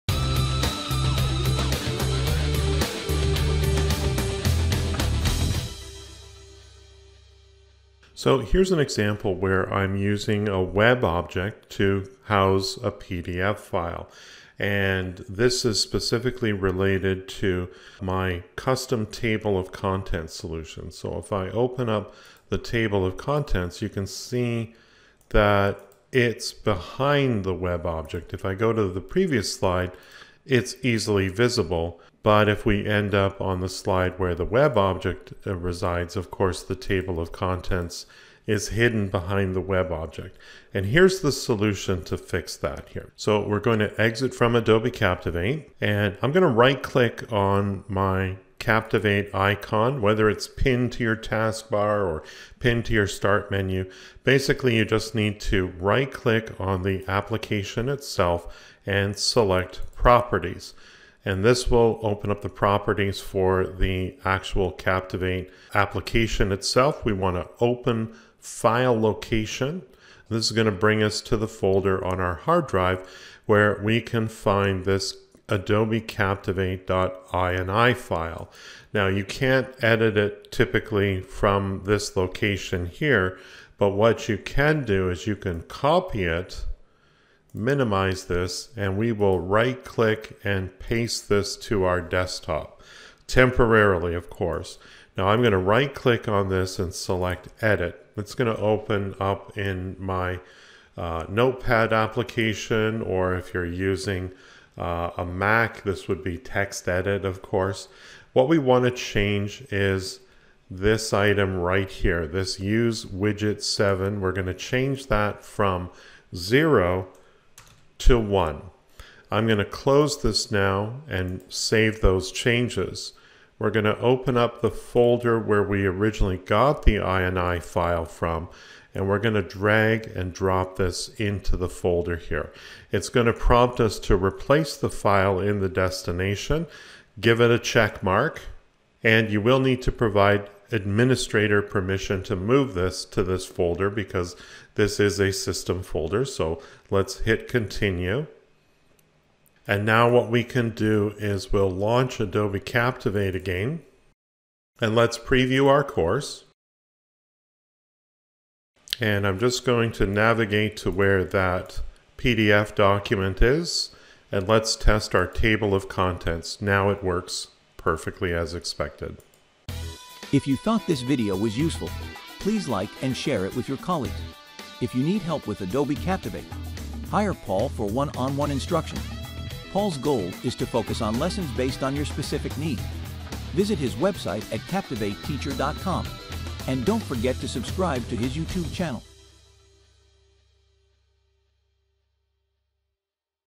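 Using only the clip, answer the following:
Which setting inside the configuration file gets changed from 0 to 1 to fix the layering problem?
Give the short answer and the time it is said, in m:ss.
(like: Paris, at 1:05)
use widget 7, at 1:52.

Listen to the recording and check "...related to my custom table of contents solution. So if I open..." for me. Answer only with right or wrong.
right.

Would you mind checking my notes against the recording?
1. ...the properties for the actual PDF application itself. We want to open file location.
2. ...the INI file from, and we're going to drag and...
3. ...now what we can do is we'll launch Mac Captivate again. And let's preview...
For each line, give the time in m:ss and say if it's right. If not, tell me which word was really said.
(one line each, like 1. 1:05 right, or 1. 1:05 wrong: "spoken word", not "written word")
1. 1:02 wrong: "Captivate", not "PDF"
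2. 2:06 right
3. 2:29 wrong: "Adobe", not "Mac".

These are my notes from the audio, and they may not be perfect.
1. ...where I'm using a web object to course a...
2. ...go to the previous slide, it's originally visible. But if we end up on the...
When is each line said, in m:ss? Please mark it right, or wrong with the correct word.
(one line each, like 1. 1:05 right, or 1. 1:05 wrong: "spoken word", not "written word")
1. 0:09 wrong: "house", not "course"
2. 0:28 wrong: "easily", not "originally".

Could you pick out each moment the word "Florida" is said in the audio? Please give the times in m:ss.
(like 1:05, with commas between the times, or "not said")
not said.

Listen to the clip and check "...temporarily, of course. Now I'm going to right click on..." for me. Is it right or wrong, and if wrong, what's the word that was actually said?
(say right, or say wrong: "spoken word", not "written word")
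right.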